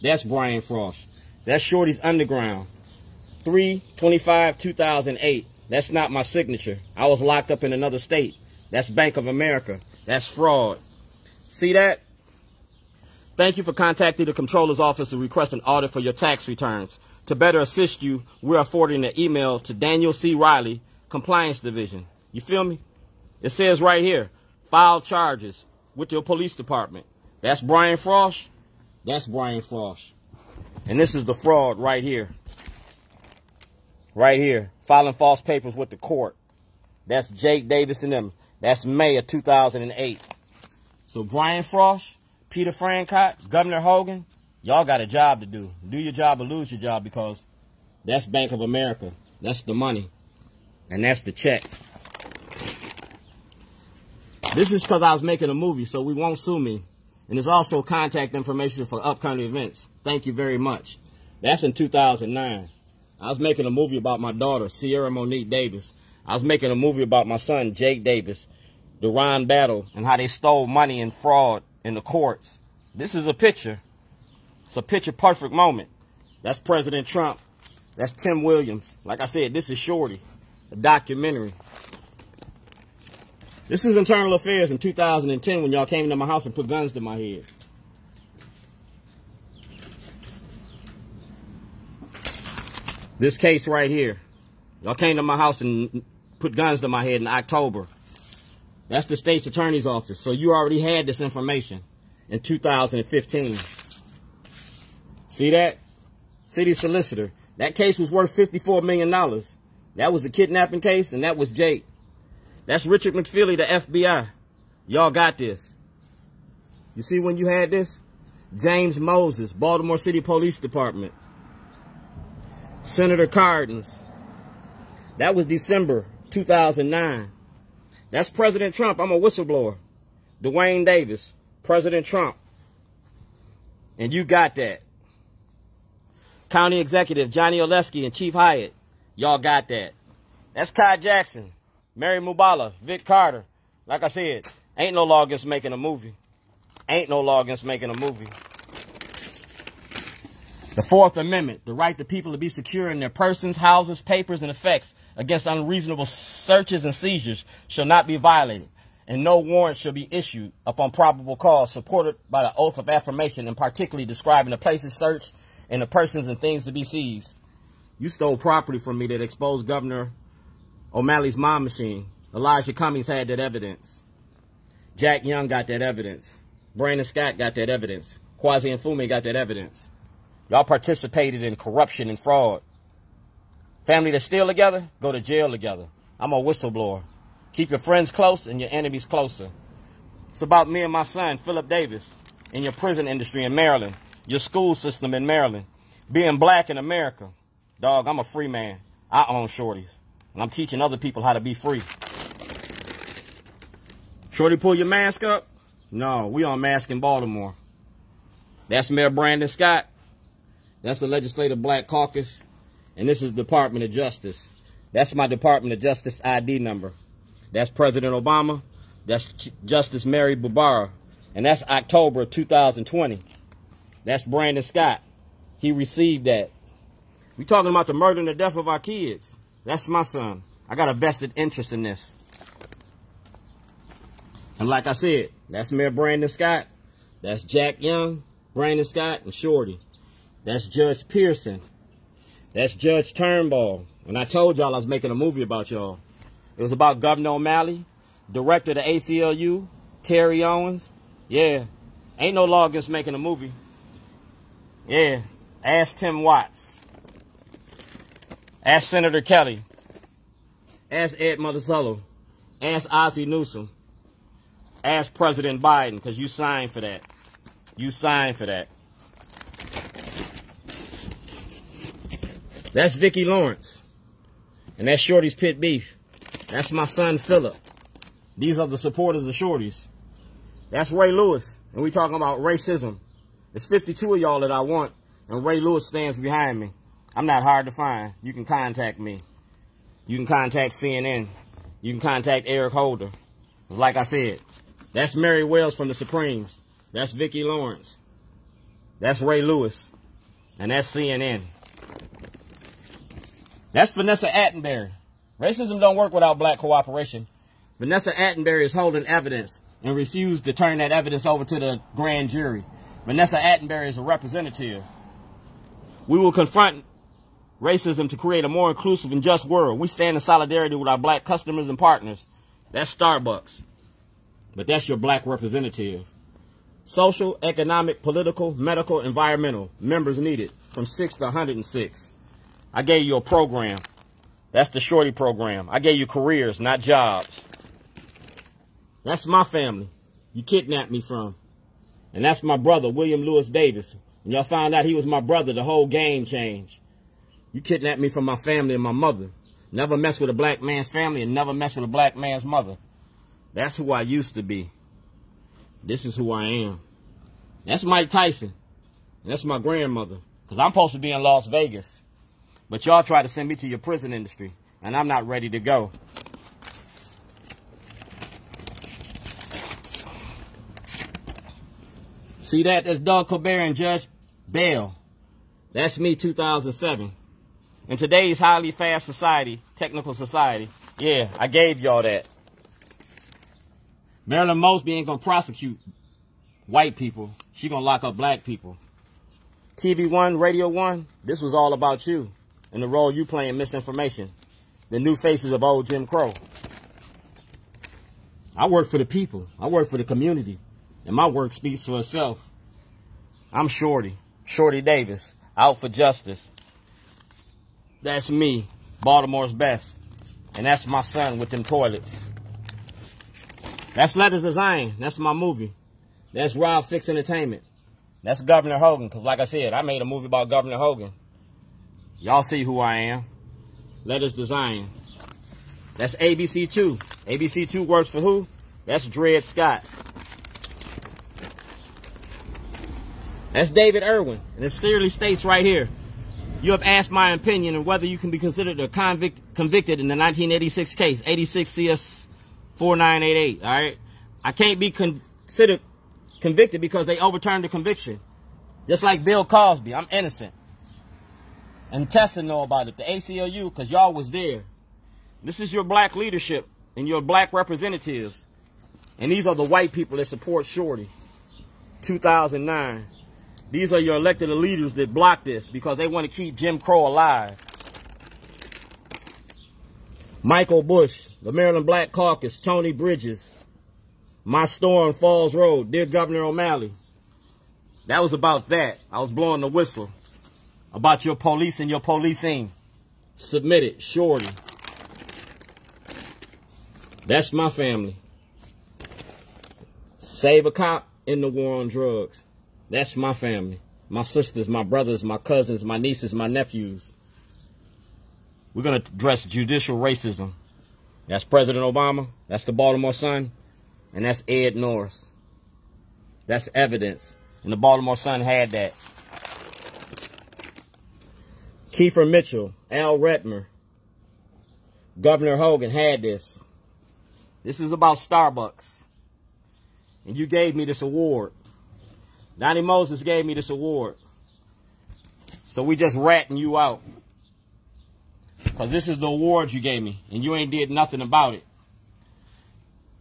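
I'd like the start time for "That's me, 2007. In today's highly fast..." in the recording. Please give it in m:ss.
6:15.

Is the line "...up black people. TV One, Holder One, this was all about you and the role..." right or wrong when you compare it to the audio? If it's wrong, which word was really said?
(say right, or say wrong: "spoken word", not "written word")
wrong: "Radio", not "Holder".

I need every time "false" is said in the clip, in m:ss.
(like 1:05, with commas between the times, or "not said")
0:35.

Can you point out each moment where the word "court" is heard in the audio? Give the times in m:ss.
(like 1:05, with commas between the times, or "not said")
0:35, 1:12.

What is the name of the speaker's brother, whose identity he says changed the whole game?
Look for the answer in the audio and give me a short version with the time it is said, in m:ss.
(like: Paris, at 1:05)
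William Lewis Davis, at 5:42.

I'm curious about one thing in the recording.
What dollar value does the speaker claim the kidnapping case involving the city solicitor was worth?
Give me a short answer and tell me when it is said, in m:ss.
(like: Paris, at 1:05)
$54 million, at 1:48.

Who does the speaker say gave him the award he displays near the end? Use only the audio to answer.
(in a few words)
Donnie Moses.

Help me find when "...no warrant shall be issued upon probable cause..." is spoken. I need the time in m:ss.
2:39.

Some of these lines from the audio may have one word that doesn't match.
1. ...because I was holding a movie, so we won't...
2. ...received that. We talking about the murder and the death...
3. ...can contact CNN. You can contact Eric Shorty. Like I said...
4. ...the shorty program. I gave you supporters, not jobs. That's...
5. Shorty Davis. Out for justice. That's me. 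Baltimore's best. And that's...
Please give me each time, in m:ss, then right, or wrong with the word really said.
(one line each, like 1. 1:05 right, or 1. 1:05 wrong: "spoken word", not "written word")
1. 0:54 wrong: "making", not "holding"
2. 3:45 right
3. 4:50 wrong: "Holder", not "Shorty"
4. 5:34 wrong: "careers", not "supporters"
5. 6:44 right.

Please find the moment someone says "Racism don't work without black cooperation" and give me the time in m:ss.
5:05.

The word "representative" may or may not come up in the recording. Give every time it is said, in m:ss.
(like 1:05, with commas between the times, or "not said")
5:14, 5:25, 7:37.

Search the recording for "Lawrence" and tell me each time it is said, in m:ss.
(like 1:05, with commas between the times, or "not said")
4:33, 4:57.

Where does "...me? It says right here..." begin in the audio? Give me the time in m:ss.
0:22.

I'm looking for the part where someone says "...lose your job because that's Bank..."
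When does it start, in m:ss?
0:46.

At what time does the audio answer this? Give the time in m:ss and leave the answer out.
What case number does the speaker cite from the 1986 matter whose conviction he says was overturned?
7:21.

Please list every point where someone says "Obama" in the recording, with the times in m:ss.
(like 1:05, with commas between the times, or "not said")
3:38, 8:21.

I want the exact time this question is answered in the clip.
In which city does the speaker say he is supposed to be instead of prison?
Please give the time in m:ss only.
6:01.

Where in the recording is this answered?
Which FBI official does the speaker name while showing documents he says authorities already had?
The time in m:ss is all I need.
1:52.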